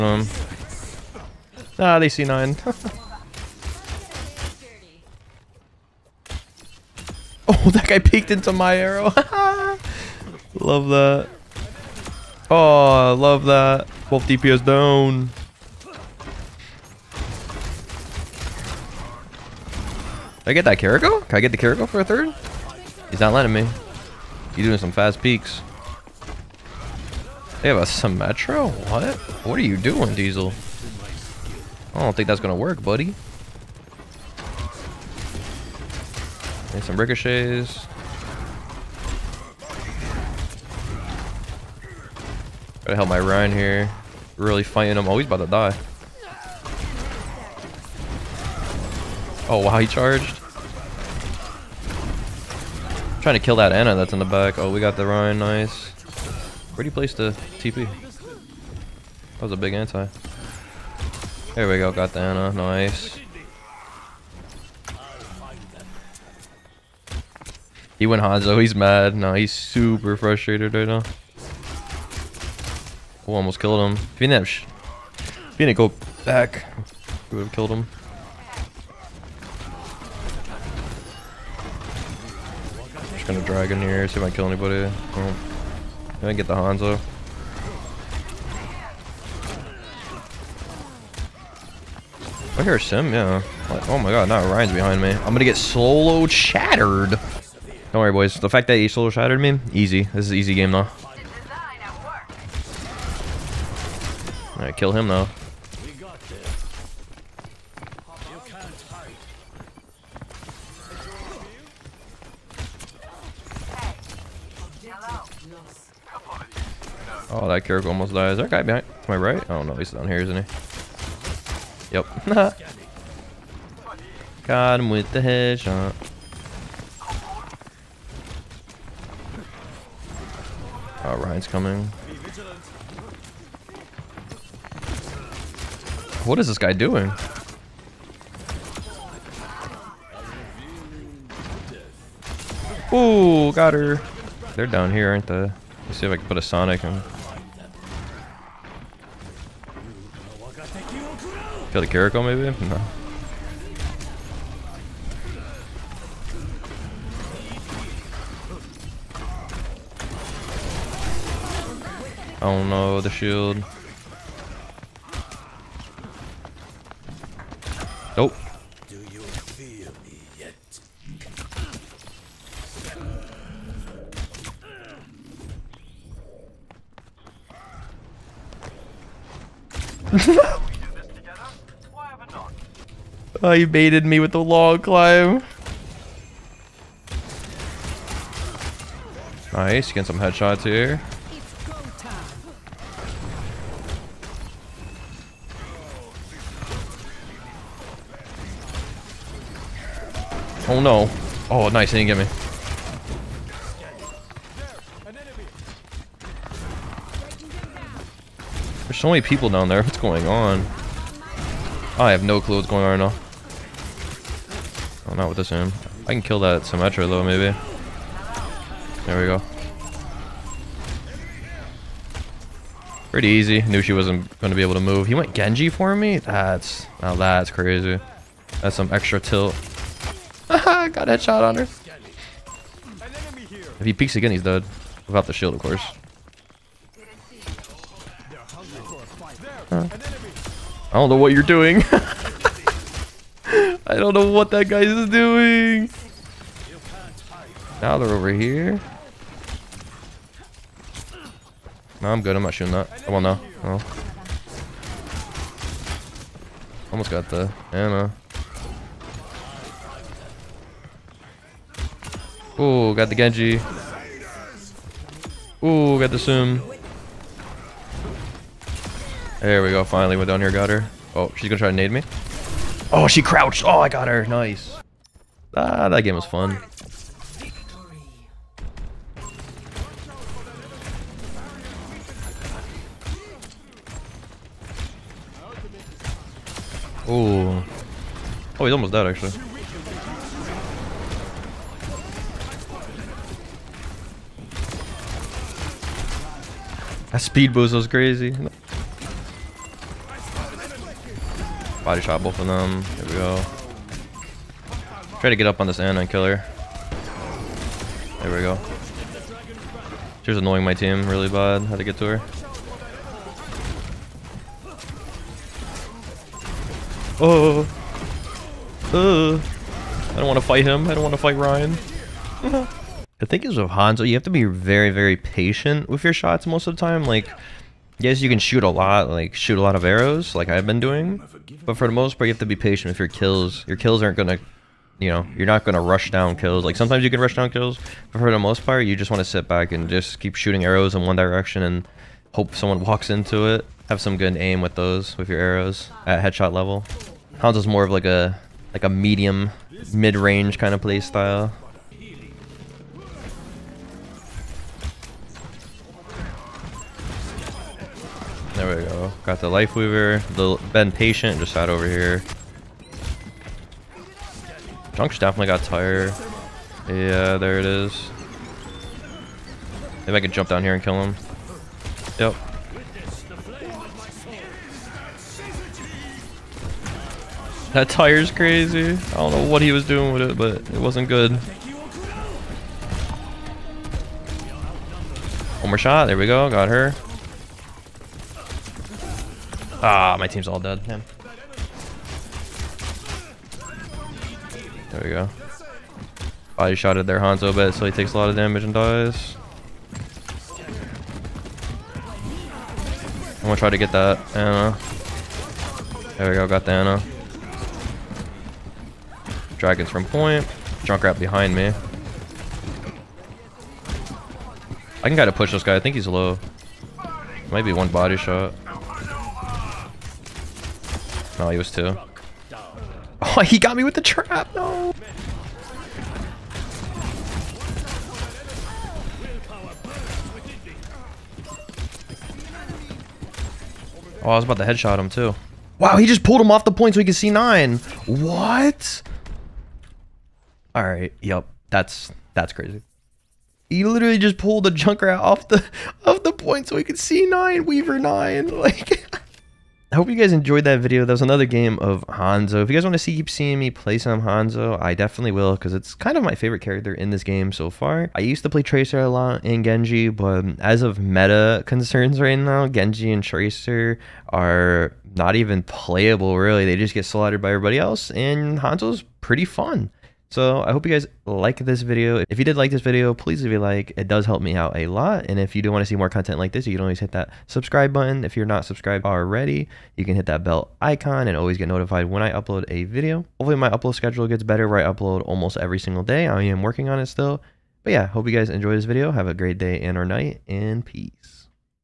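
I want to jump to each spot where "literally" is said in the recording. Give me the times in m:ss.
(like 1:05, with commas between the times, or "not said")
7:23.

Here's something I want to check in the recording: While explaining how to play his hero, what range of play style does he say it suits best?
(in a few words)
medium, mid-range.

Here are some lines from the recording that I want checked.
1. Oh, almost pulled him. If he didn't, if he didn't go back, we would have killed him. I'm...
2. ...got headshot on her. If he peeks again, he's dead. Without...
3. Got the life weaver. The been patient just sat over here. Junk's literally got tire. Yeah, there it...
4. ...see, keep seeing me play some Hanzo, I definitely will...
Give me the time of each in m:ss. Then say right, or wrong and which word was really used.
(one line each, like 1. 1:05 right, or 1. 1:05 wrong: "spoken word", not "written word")
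1. 1:13 wrong: "killed", not "pulled"
2. 3:50 right
3. 5:59 wrong: "definitely", not "literally"
4. 7:32 right.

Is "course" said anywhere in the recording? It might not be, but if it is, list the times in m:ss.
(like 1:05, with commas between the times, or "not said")
3:55.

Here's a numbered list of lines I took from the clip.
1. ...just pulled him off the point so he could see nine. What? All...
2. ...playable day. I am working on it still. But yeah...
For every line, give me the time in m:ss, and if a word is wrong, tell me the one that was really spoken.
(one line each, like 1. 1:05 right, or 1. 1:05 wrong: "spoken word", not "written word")
1. 7:16 right
2. 8:05 wrong: "single", not "playable".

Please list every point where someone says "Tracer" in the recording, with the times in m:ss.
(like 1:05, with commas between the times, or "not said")
7:38, 7:43.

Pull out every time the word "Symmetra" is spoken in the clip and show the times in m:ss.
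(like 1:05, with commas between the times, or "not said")
0:27, 3:36.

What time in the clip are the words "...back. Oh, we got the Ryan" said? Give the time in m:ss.
0:54.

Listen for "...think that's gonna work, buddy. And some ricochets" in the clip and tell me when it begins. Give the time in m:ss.
0:32.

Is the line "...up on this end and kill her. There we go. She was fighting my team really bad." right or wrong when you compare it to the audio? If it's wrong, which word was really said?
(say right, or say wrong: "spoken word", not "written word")
wrong: "annoying", not "fighting".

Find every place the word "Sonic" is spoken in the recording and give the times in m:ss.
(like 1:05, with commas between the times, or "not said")
2:26.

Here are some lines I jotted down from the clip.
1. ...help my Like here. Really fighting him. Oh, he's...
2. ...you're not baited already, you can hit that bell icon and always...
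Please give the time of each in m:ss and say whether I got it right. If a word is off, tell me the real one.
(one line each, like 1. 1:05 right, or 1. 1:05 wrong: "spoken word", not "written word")
1. 0:42 wrong: "Ryan", not "Like"
2. 7:58 wrong: "subscribed", not "baited".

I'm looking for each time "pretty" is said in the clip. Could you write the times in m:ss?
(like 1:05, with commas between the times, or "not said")
3:43, 7:49.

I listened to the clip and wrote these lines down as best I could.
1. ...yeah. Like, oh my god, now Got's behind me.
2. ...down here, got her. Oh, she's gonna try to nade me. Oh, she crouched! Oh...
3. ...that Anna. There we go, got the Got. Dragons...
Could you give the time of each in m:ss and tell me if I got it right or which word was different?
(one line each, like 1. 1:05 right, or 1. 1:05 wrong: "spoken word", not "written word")
1. 1:33 wrong: "Ryan", not "Got"
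2. 4:30 right
3. 6:43 wrong: "Anna", not "Got".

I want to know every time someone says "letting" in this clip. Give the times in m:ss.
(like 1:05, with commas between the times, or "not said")
0:23.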